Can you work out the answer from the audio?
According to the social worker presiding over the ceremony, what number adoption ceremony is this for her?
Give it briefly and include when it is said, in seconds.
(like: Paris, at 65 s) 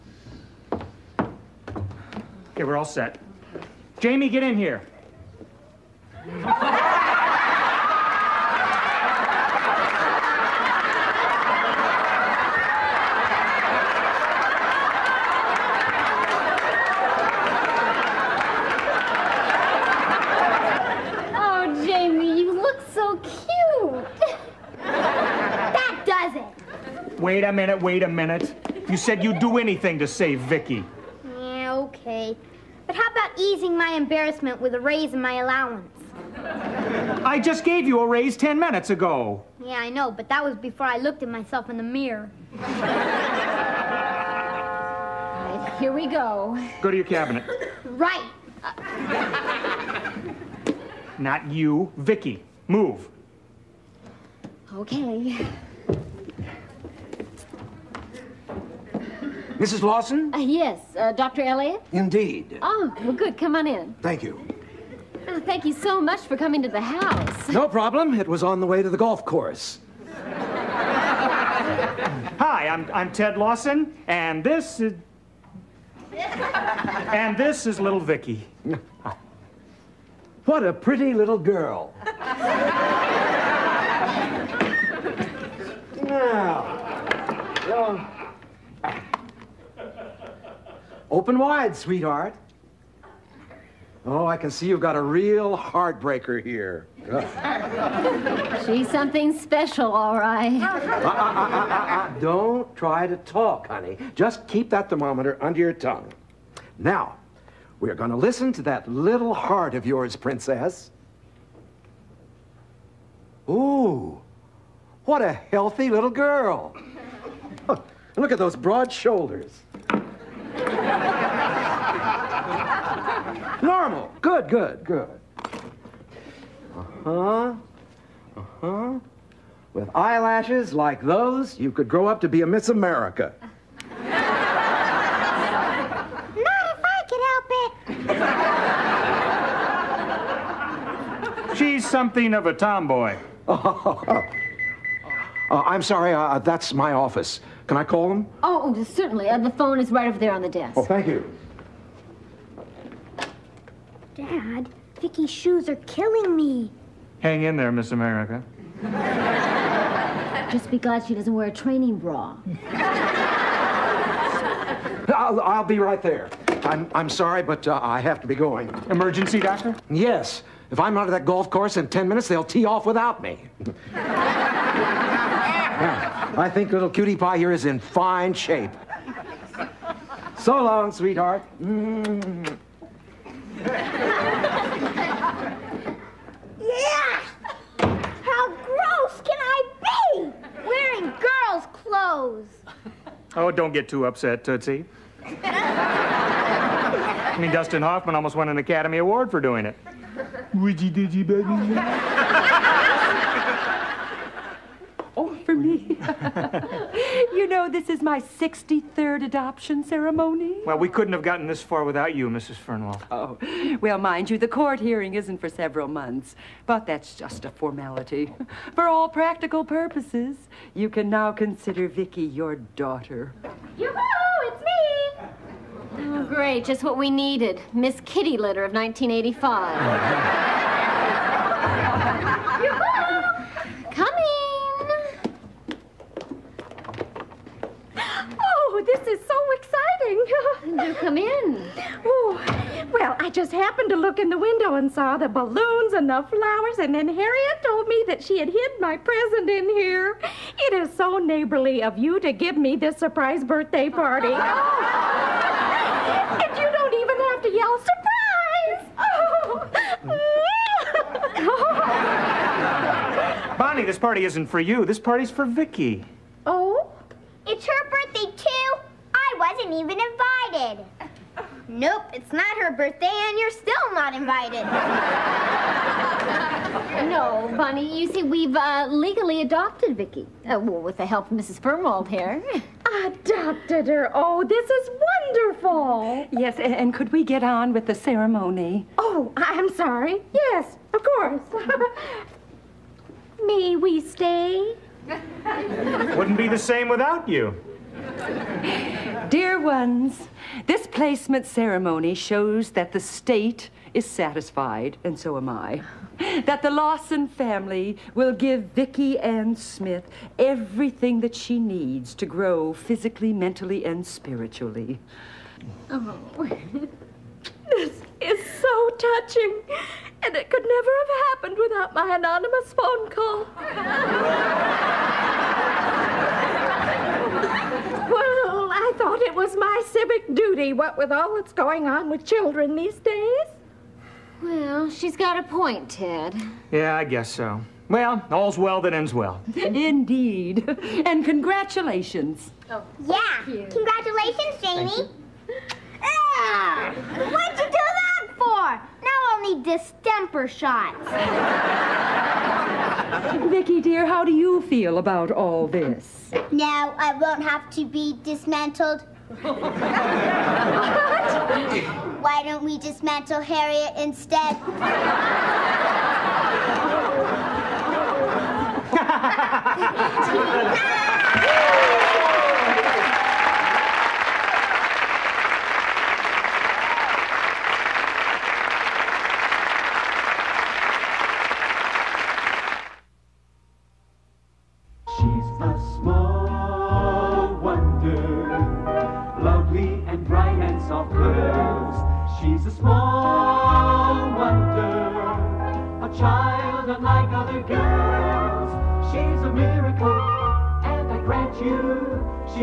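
63rd, at 208 s.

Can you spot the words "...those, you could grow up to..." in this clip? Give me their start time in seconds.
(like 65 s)
130 s.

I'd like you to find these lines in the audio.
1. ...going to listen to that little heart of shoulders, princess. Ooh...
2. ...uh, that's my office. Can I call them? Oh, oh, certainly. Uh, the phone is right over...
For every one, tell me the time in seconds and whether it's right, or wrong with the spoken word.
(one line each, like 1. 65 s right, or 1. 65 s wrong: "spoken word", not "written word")
1. 107 s wrong: "yours", not "shoulders"
2. 146 s right.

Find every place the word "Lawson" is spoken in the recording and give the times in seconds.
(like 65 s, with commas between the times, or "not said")
59 s, 73 s, 306 s.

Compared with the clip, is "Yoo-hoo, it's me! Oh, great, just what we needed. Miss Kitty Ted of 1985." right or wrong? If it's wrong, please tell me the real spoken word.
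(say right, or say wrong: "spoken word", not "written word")
wrong: "Litter", not "Ted".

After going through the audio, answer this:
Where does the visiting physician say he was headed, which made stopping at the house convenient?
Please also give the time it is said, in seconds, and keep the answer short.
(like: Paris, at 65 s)
the golf course, at 68 s.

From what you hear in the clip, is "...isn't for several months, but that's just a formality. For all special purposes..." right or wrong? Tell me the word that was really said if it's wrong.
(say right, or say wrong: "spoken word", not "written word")
wrong: "practical", not "special".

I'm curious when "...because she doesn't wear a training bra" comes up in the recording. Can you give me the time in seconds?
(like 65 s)
160 s.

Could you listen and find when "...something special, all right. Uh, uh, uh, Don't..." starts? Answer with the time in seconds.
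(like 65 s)
98 s.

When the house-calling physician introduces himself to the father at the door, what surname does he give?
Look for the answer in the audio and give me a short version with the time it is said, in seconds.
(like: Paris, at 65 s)
Elliot, at 61 s.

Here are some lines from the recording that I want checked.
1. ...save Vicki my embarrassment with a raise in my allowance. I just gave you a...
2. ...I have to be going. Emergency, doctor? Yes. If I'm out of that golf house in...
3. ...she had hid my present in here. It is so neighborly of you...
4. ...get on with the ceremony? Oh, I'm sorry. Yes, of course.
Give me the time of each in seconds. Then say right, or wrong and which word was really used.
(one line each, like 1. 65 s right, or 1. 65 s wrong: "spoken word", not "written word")
1. 30 s right
2. 167 s wrong: "course", not "house"
3. 248 s right
4. 287 s right.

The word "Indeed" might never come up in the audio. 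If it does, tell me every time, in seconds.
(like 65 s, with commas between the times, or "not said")
61 s, 339 s.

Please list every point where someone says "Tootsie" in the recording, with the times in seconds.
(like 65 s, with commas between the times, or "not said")
194 s.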